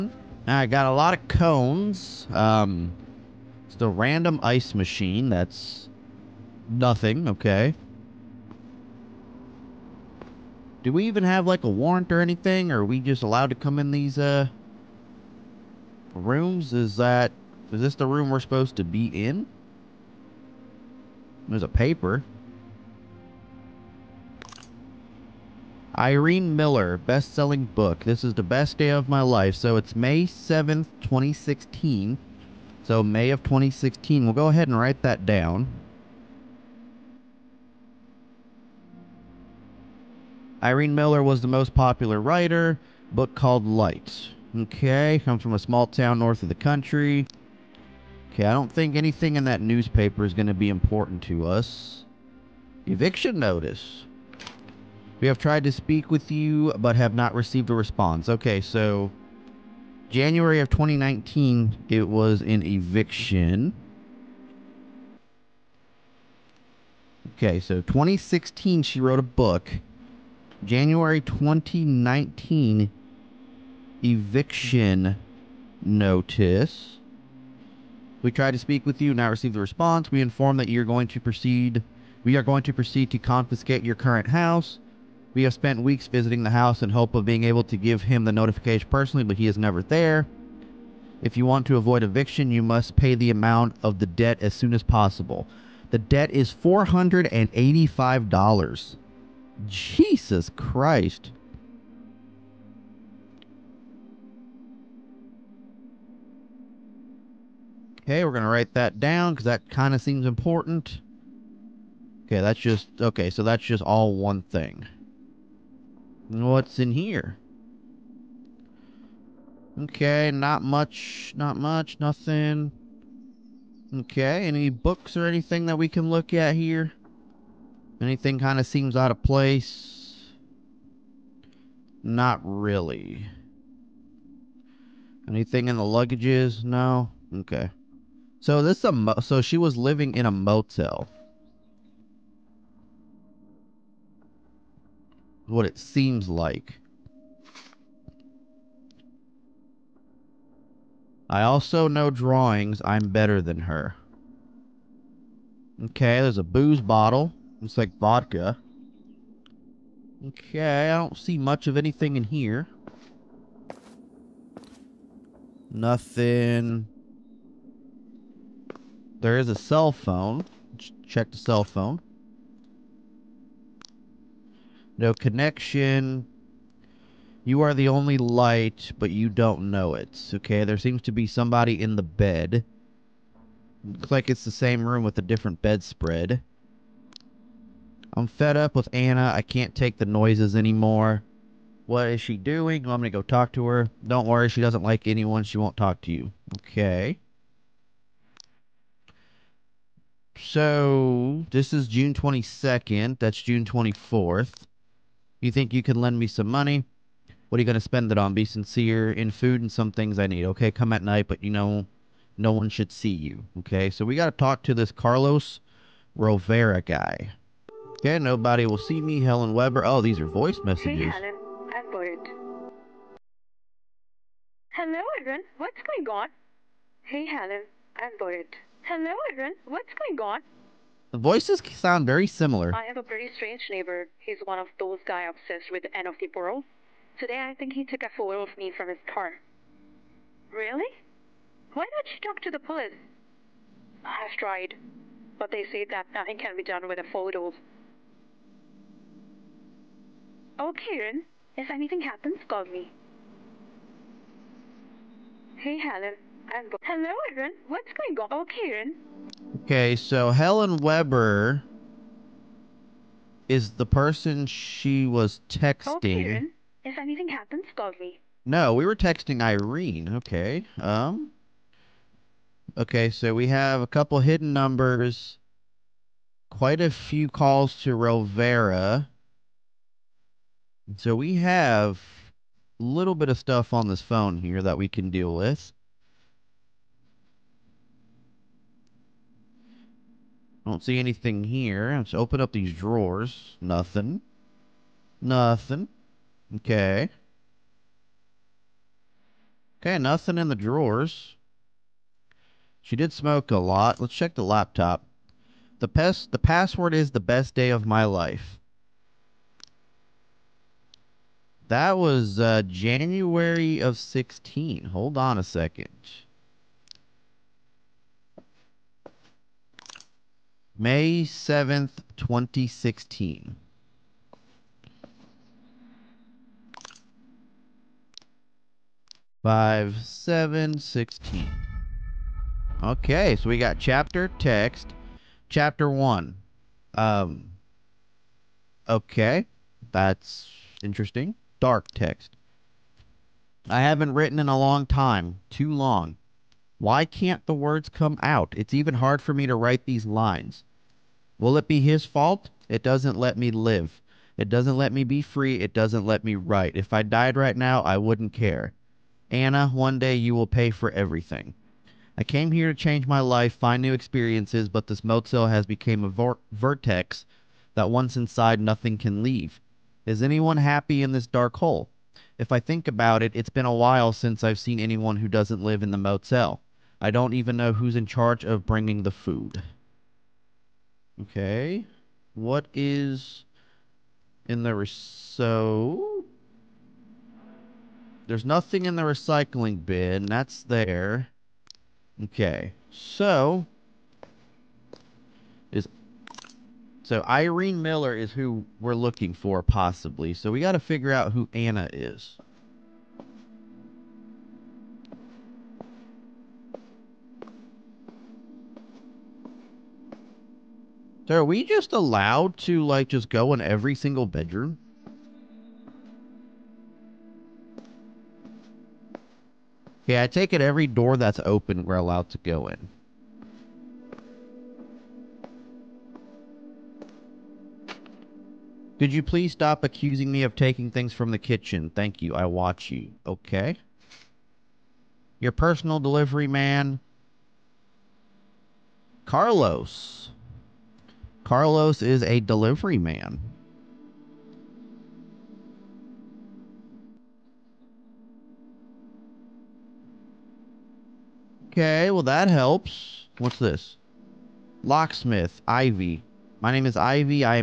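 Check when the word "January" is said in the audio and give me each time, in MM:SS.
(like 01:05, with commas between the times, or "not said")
01:00, 01:10, 05:12.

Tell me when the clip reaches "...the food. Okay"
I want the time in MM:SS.
06:19.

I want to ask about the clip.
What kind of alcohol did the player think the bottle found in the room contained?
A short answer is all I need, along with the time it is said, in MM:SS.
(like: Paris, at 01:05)
Vodka, at 02:37.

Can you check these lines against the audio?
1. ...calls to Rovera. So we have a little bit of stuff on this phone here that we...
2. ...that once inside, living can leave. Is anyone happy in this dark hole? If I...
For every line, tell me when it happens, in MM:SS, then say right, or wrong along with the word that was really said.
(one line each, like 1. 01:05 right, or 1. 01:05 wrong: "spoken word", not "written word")
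1. 04:37 right
2. 06:07 wrong: "nothing", not "living".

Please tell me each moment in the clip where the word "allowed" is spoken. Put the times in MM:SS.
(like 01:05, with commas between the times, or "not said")
00:13, 06:51, 07:01.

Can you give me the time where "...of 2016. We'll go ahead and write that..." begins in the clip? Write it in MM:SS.
00:33.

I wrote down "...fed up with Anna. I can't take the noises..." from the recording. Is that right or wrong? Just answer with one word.
right.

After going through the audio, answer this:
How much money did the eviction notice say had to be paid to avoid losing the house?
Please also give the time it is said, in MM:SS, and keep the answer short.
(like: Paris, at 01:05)
$485, at 01:36.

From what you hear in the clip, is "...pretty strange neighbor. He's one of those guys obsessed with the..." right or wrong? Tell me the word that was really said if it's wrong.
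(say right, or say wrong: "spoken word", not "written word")
right.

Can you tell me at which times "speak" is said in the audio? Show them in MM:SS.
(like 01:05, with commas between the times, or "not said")
00:55, 01:18.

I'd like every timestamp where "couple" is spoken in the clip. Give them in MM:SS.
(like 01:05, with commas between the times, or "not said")
04:33.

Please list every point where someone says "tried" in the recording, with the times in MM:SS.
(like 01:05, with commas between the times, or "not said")
00:55, 01:18, 04:04.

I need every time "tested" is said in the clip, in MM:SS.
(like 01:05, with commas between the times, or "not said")
not said.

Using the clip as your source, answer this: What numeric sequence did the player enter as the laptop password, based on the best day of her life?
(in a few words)
5716.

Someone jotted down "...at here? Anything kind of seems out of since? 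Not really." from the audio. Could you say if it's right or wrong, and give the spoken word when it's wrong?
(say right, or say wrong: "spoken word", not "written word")
wrong: "place", not "since".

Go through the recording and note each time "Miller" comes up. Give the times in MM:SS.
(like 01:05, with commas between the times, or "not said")
00:26, 00:40, 06:37.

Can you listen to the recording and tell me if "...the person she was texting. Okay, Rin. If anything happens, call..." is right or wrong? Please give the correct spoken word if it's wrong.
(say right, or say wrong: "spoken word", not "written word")
right.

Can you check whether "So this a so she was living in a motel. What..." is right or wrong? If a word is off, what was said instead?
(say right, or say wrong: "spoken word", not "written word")
right.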